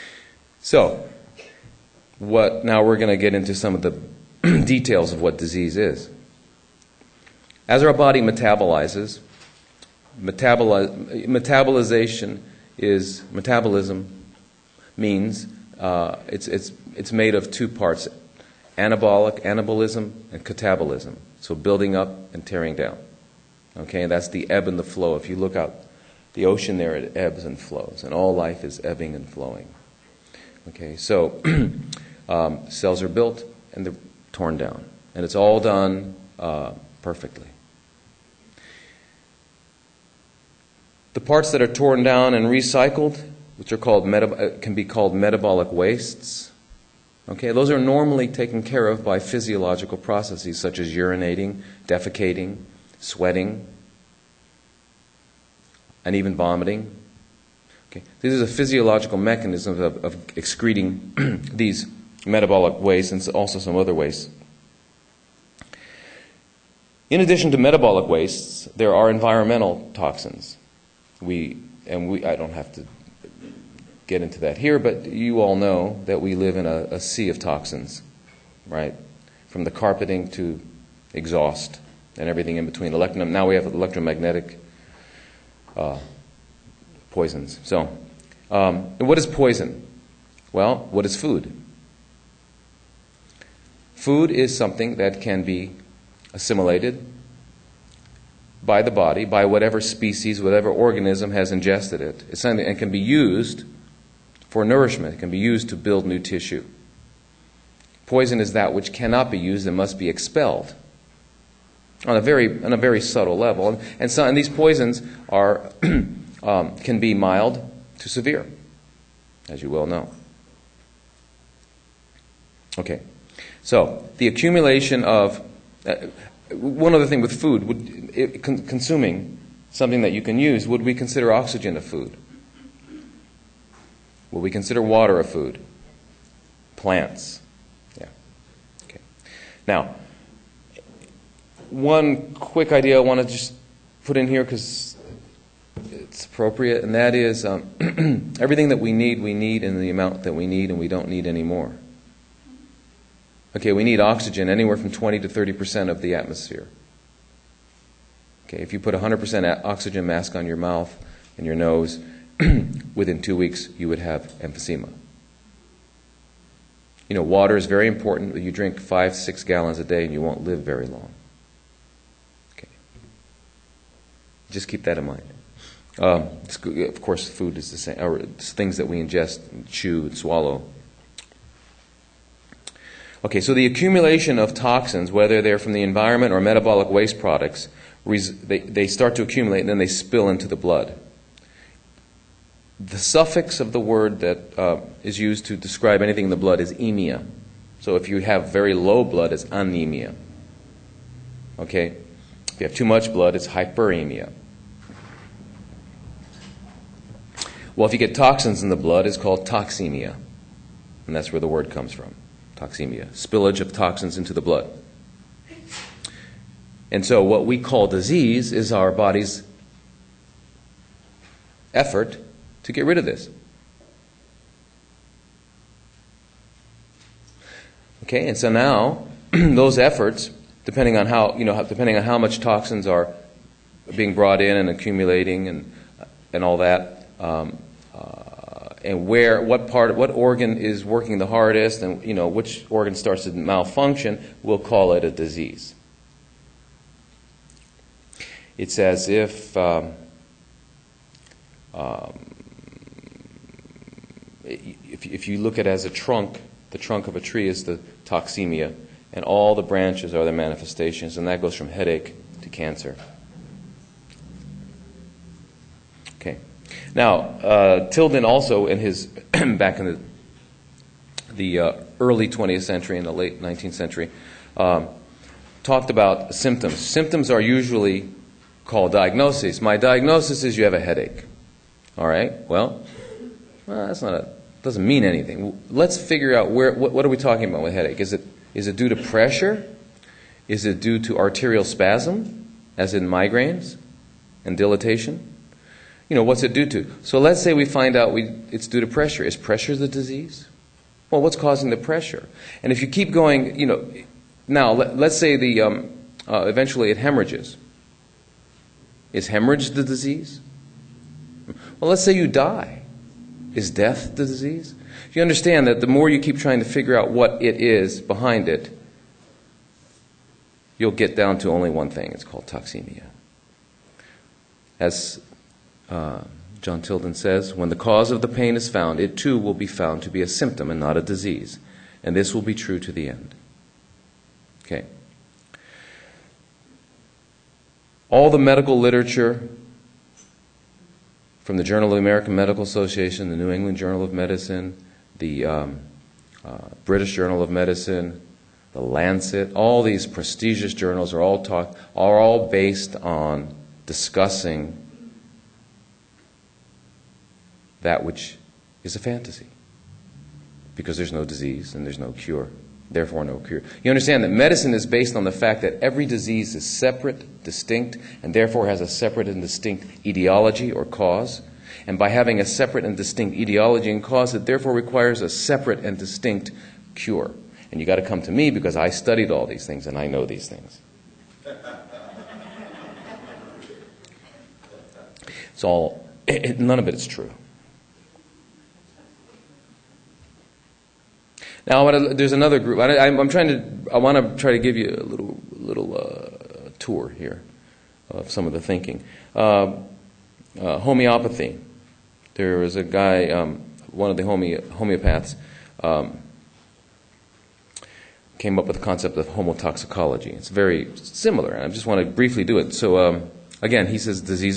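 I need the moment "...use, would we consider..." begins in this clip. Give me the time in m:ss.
2:10.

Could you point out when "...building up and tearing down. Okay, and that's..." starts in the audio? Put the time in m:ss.
0:21.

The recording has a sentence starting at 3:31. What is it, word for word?
And that's where the word comes from toxemia, spillage of toxins into the blood.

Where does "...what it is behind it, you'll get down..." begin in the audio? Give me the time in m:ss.
5:17.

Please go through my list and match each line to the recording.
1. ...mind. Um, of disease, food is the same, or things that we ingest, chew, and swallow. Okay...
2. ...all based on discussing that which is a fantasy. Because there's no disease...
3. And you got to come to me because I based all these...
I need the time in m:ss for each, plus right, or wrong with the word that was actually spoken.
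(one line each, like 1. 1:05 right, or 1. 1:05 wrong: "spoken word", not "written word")
1. 2:55 wrong: "course", not "disease"
2. 5:52 right
3. 6:17 wrong: "studied", not "based".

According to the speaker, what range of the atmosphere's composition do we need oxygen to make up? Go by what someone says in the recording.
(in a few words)
20 to 30 percent.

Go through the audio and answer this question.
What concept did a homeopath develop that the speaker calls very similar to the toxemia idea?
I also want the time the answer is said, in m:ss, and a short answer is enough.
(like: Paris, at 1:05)
homotoxicology, at 6:49.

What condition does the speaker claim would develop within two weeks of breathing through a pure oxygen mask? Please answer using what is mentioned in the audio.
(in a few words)
emphysema.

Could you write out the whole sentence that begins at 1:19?
From the carpeting to exhaust and everything in between.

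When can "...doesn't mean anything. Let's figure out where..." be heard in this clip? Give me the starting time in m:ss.
4:44.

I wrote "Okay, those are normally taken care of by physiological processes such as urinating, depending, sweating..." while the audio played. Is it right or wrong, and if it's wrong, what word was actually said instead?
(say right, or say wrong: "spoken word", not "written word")
wrong: "defecating", not "depending".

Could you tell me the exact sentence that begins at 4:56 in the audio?
You know, what's it due to?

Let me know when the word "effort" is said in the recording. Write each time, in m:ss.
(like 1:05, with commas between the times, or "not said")
3:41, 3:49.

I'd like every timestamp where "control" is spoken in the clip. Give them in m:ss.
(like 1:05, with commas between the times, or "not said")
not said.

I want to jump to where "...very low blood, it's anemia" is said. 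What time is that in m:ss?
3:18.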